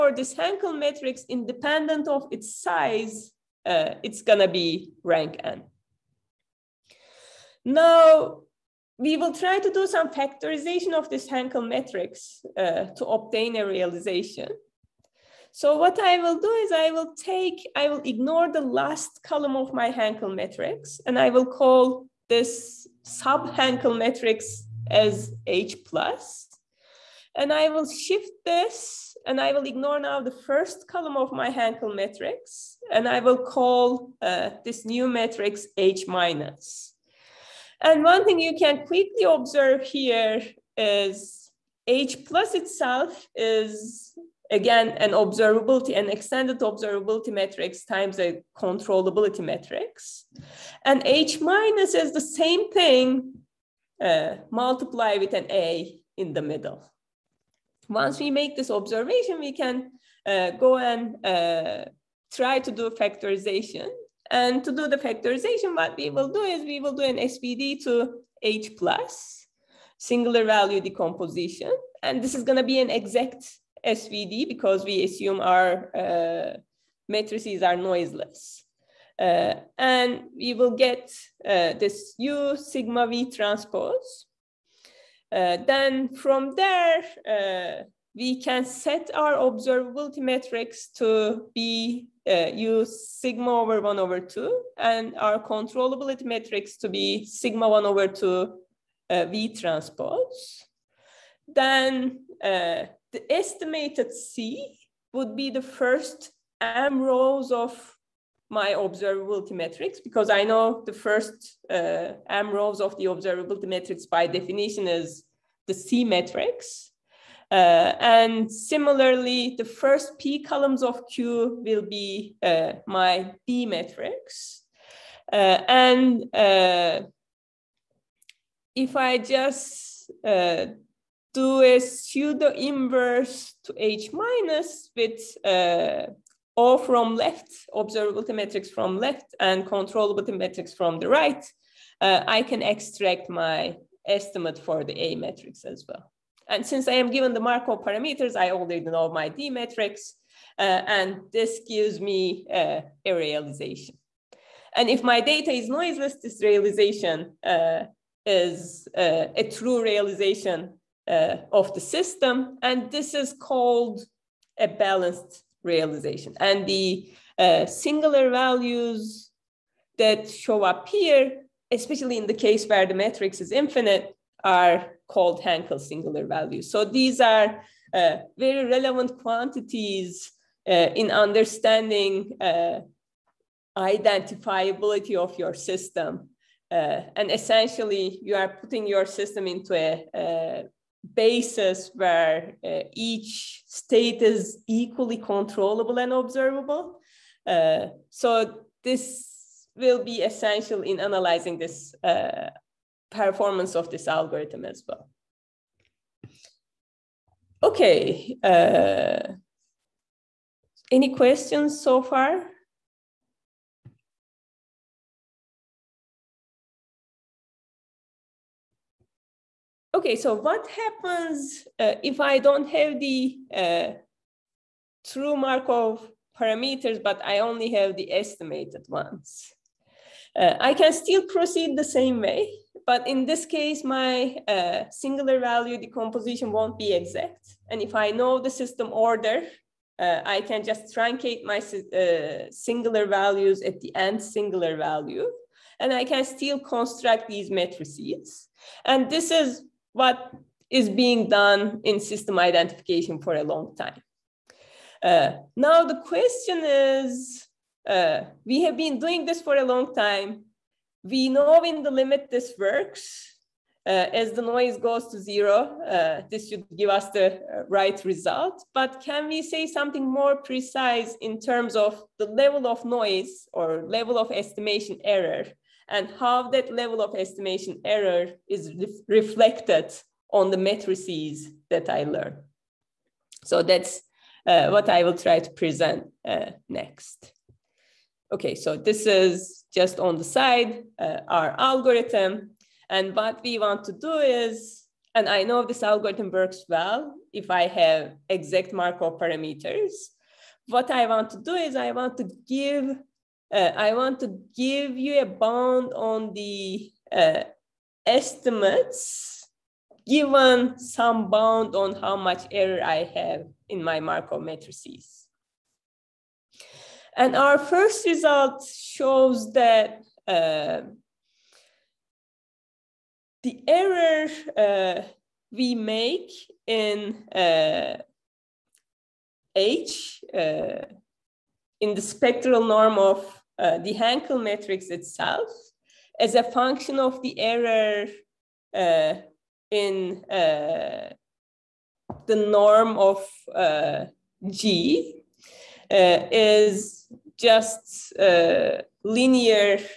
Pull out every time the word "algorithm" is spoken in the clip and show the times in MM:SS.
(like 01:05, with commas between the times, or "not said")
03:24, 04:51, 04:55.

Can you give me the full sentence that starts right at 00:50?
And H minus is the same thing, uh, multiply with an A in the middle.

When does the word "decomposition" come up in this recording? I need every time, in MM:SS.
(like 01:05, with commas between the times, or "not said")
01:10, 03:55.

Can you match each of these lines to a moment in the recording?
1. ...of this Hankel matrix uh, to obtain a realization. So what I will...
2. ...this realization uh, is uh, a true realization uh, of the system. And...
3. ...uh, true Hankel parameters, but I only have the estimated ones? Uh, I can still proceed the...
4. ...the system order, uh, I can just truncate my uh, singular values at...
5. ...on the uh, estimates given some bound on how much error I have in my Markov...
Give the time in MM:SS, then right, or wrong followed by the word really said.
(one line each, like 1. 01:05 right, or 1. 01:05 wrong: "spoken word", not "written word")
1. 00:10 right
2. 02:36 right
3. 03:43 wrong: "Markov", not "Hankel"
4. 03:58 right
5. 05:05 right.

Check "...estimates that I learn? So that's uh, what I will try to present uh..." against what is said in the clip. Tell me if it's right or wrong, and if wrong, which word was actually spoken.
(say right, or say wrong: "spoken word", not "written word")
wrong: "matrices", not "estimates".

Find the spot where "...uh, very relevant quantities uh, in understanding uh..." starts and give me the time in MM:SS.
02:57.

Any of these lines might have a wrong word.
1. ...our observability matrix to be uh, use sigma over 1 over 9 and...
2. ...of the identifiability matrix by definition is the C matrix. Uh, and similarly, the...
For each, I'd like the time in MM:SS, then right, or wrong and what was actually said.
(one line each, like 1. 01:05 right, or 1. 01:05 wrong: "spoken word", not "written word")
1. 01:29 wrong: "2", not "9"
2. 01:52 wrong: "observability", not "identifiability".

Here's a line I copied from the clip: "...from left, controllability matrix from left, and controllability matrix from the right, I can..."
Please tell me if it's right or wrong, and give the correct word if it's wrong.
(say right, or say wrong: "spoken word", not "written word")
wrong: "observability", not "controllability".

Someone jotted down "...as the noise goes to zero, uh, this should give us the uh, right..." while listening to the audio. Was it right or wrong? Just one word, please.
right.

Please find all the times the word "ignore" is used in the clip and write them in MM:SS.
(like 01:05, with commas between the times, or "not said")
00:18, 00:29.